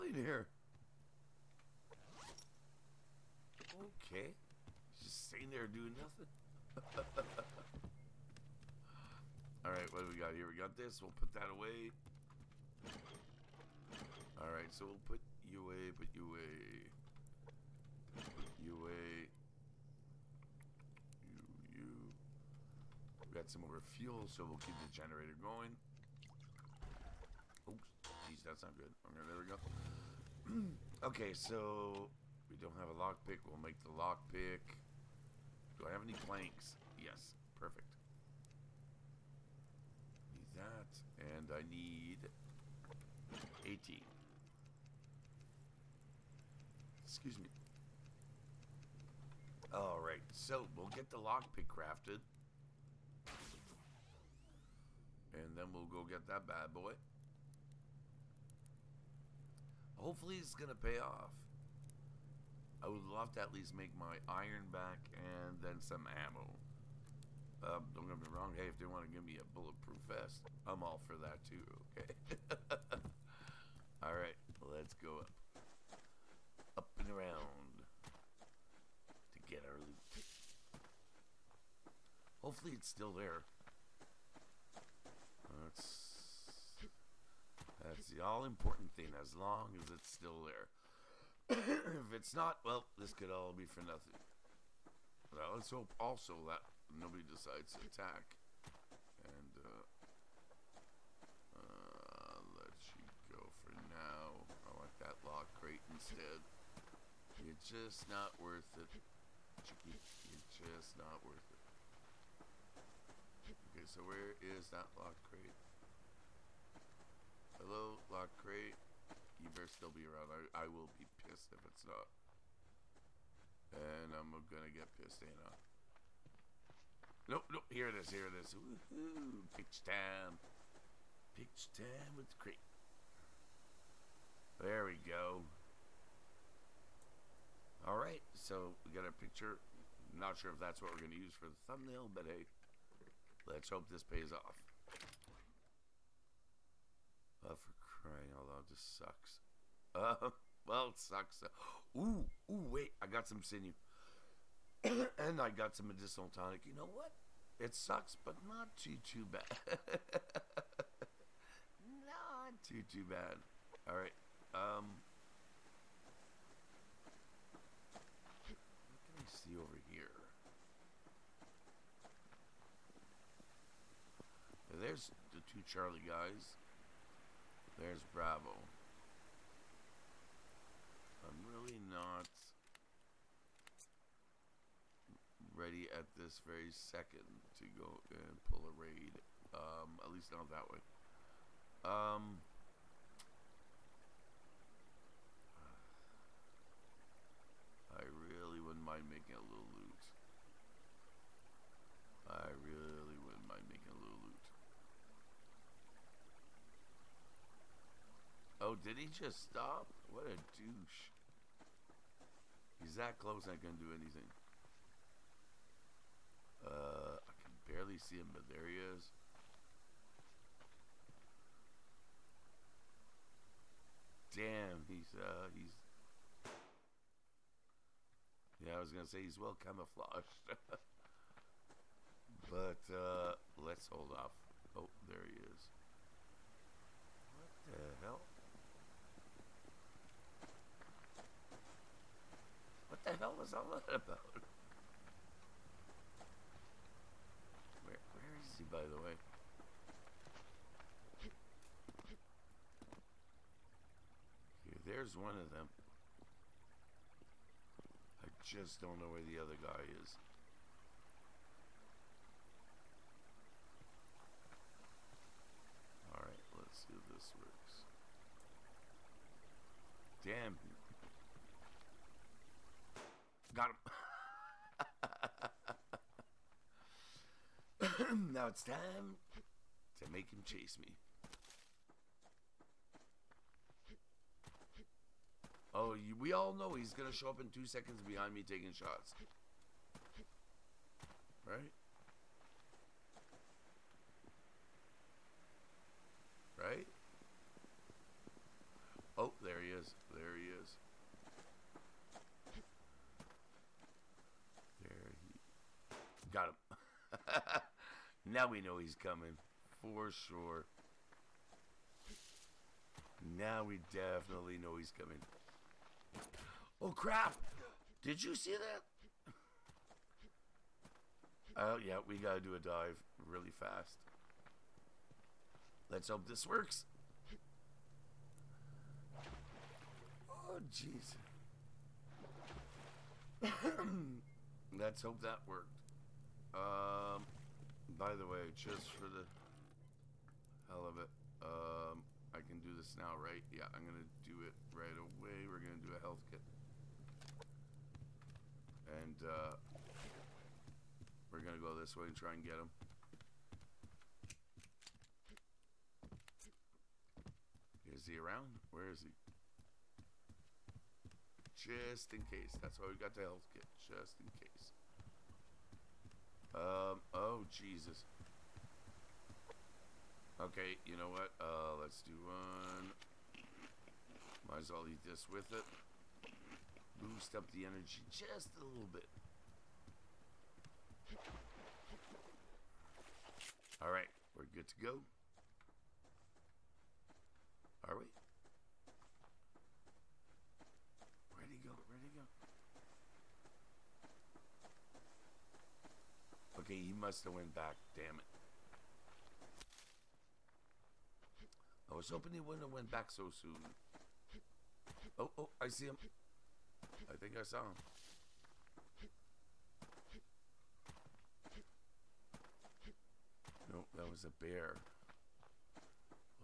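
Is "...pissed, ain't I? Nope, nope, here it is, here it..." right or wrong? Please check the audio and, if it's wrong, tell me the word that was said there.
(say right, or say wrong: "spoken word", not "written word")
right.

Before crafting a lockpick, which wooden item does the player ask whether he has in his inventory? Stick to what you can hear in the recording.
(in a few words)
Planks.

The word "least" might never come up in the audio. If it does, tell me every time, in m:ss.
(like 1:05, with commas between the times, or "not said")
1:03, 3:10.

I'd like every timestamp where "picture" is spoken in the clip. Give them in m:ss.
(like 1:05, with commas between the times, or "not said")
2:19.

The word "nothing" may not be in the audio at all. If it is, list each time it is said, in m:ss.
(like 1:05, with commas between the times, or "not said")
0:05, 1:33.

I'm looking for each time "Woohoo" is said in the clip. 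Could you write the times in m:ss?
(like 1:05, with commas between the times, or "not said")
2:08.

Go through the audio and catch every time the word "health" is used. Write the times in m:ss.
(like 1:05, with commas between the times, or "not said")
5:45, 6:03.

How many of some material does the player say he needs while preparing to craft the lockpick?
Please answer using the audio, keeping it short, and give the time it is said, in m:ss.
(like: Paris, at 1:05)
18, at 0:43.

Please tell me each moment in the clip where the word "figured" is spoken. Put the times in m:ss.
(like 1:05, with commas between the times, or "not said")
not said.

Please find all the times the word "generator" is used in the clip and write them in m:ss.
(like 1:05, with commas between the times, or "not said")
0:24.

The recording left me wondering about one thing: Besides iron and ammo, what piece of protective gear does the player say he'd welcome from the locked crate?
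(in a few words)
Bulletproof vest.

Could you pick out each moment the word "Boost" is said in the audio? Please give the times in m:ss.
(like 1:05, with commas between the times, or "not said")
6:16.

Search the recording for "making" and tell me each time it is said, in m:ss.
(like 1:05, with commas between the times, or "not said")
3:19, 3:23.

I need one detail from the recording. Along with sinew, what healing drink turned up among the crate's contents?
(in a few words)
Medicinal tonic.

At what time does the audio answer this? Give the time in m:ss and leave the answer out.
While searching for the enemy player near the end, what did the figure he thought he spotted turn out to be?
6:54.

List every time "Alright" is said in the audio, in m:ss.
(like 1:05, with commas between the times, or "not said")
0:09, 0:14, 0:49, 1:14, 2:17, 6:23.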